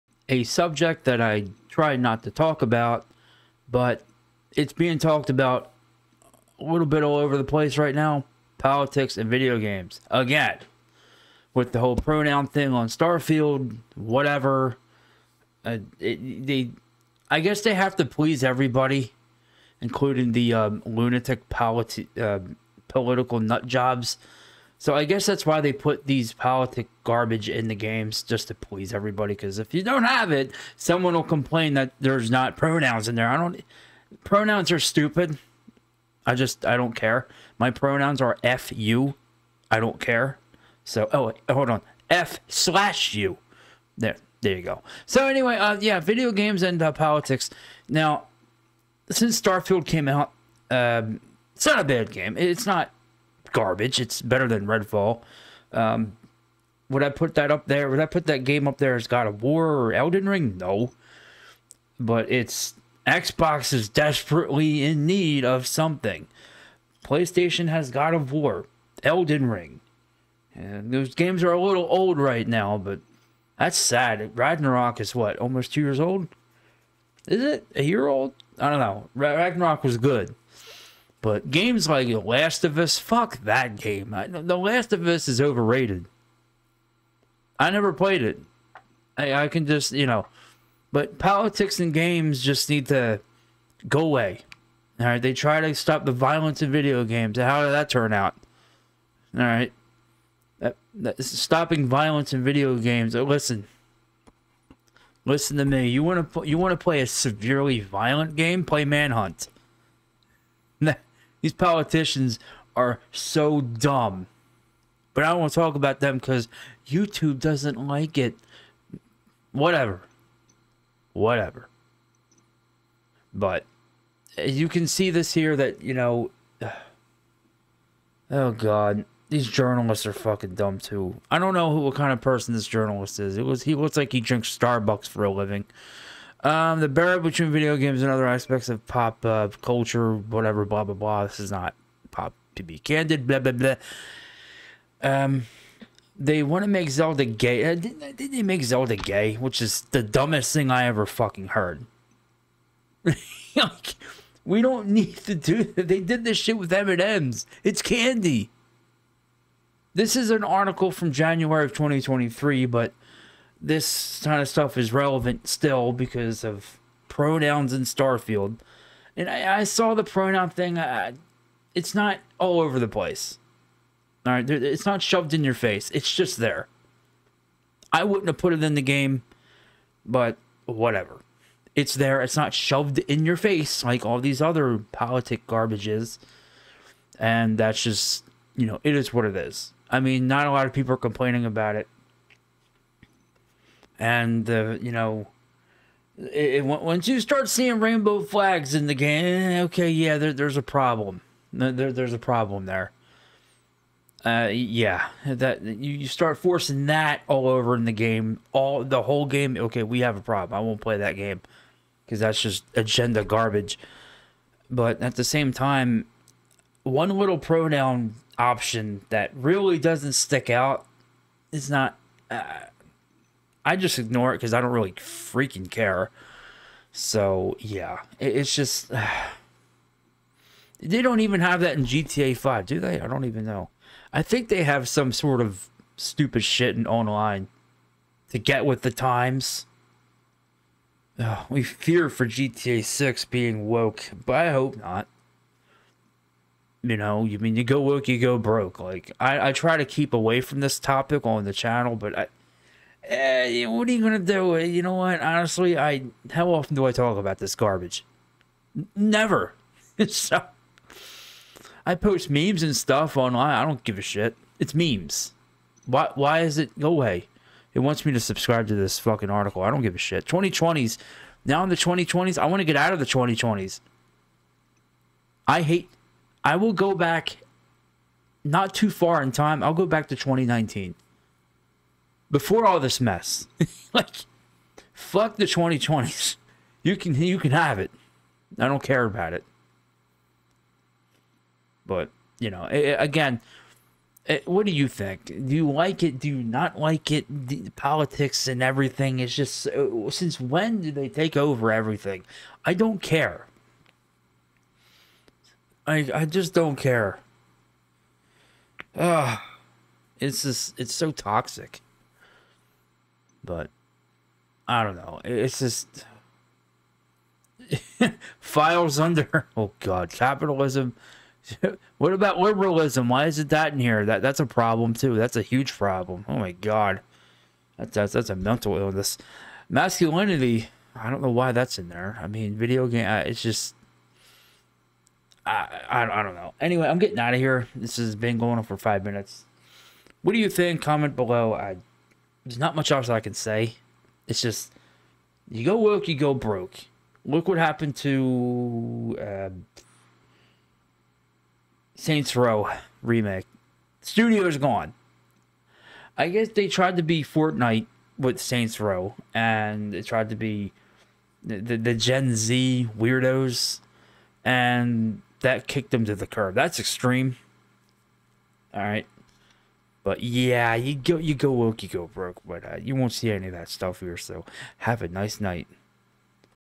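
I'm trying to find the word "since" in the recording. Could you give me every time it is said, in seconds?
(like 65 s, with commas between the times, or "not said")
49 s, 300 s.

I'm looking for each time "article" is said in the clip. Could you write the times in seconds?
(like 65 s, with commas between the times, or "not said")
160 s, 269 s.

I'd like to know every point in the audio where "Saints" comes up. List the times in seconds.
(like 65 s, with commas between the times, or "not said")
351 s, 358 s.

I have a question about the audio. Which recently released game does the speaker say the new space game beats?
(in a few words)
Redfall.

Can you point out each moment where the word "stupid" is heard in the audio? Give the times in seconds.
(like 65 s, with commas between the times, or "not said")
34 s, 235 s.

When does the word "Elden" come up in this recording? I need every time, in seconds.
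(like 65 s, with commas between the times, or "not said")
59 s, 69 s.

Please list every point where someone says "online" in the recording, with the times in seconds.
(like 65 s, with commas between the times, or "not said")
236 s, 263 s.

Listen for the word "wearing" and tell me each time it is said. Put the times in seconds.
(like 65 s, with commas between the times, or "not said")
not said.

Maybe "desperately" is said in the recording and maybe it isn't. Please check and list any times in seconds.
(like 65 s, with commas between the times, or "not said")
63 s.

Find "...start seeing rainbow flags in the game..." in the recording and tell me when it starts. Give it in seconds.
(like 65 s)
197 s.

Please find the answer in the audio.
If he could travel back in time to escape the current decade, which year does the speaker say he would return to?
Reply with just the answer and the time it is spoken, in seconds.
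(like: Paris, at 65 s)
2019, at 280 s.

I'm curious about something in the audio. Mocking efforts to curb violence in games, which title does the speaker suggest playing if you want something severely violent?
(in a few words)
Manhunt.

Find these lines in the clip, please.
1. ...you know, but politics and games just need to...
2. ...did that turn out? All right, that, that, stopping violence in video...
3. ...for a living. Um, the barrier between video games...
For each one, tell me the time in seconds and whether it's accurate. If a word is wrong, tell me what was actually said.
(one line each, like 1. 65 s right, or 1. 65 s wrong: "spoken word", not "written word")
1. 89 s right
2. 97 s right
3. 135 s right.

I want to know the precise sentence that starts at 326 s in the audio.
Oh my God, that's that's, that's a mental illness.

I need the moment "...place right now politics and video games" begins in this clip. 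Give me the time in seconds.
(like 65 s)
7 s.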